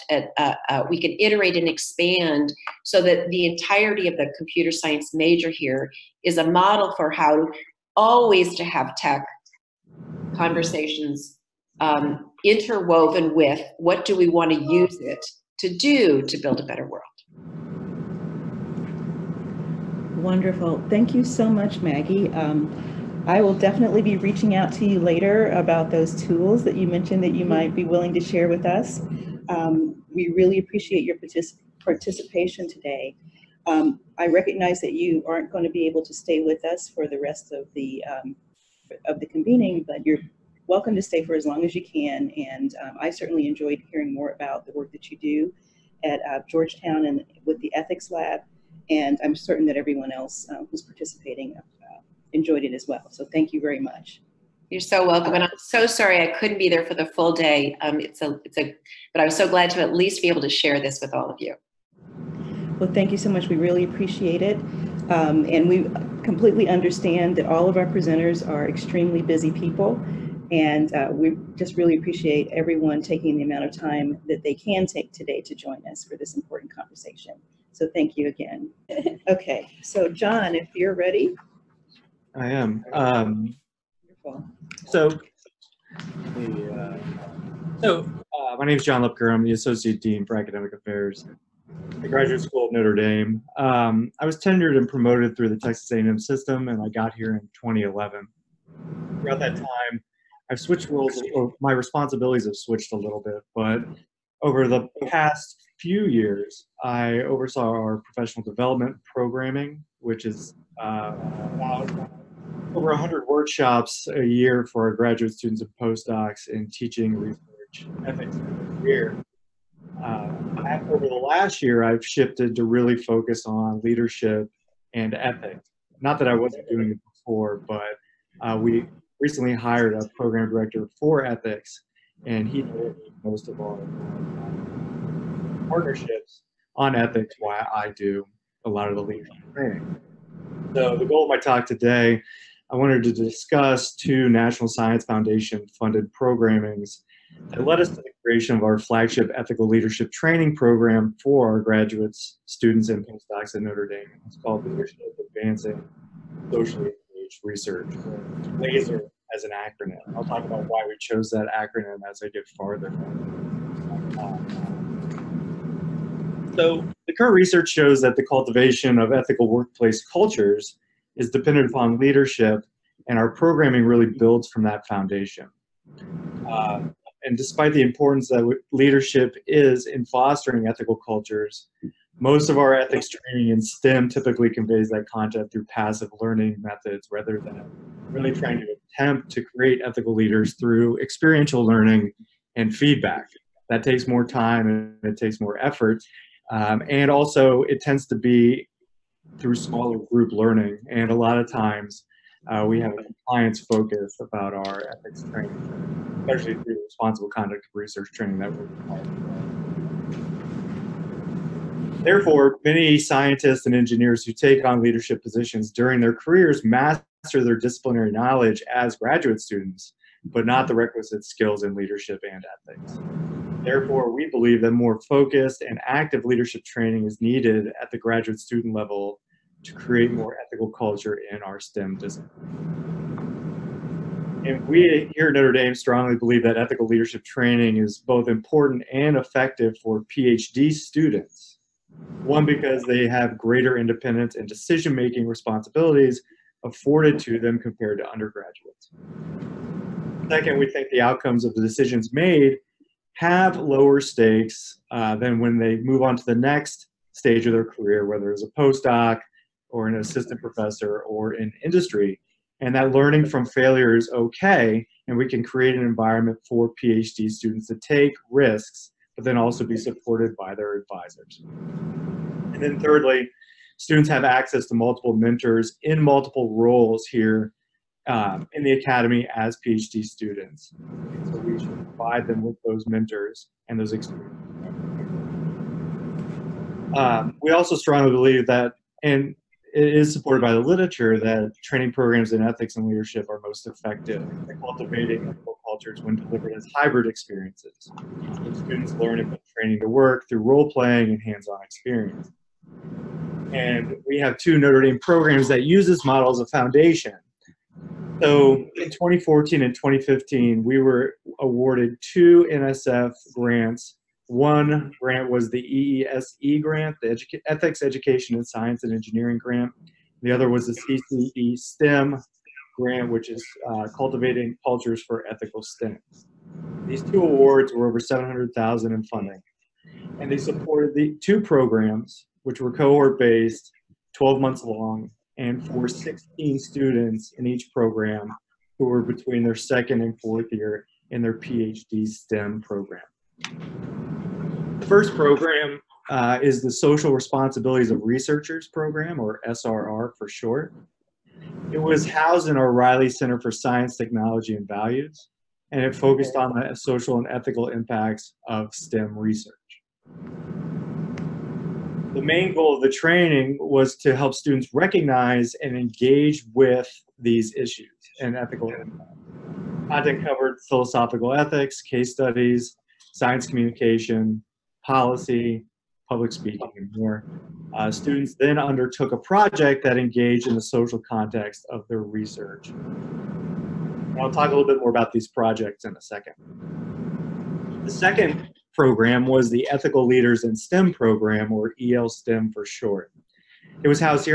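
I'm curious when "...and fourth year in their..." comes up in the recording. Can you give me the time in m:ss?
5:40.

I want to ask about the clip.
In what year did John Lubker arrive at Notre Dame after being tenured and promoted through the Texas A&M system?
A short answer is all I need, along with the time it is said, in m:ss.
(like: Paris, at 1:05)
2011, at 1:37.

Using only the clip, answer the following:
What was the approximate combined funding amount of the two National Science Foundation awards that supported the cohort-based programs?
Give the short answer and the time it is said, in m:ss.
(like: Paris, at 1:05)
Over 700,000, at 5:27.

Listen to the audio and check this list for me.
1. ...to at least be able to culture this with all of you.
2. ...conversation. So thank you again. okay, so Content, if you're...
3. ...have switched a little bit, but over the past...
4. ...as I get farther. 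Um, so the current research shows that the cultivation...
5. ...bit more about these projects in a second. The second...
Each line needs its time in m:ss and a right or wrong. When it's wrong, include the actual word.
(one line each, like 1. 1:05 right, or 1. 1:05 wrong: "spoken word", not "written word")
1. 0:59 wrong: "share", not "culture"
2. 1:16 wrong: "John", not "Content"
3. 1:42 right
4. 2:42 right
5. 6:24 right.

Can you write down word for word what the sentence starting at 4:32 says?
And then thirdly, students have access to multiple mentors in multiple roles here um, in the academy as PhD students.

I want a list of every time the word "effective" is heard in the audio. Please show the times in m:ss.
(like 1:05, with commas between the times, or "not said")
3:59, 4:53.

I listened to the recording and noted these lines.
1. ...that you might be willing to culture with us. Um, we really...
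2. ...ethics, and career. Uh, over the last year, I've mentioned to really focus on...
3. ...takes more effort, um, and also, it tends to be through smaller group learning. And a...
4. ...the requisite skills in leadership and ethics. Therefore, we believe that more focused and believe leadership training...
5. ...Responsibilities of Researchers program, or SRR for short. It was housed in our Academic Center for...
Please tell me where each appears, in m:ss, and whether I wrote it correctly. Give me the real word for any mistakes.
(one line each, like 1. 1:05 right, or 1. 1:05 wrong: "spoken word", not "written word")
1. 0:27 wrong: "share", not "culture"
2. 1:58 wrong: "shifted", not "mentioned"
3. 3:15 right
4. 3:40 wrong: "active", not "believe"
5. 5:47 wrong: "Reilly", not "Academic".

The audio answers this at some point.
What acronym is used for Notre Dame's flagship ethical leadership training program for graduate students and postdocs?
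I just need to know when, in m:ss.
2:38.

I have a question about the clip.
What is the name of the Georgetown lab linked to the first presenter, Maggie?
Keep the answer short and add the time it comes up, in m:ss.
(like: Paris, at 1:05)
Ethics Lab, at 0:47.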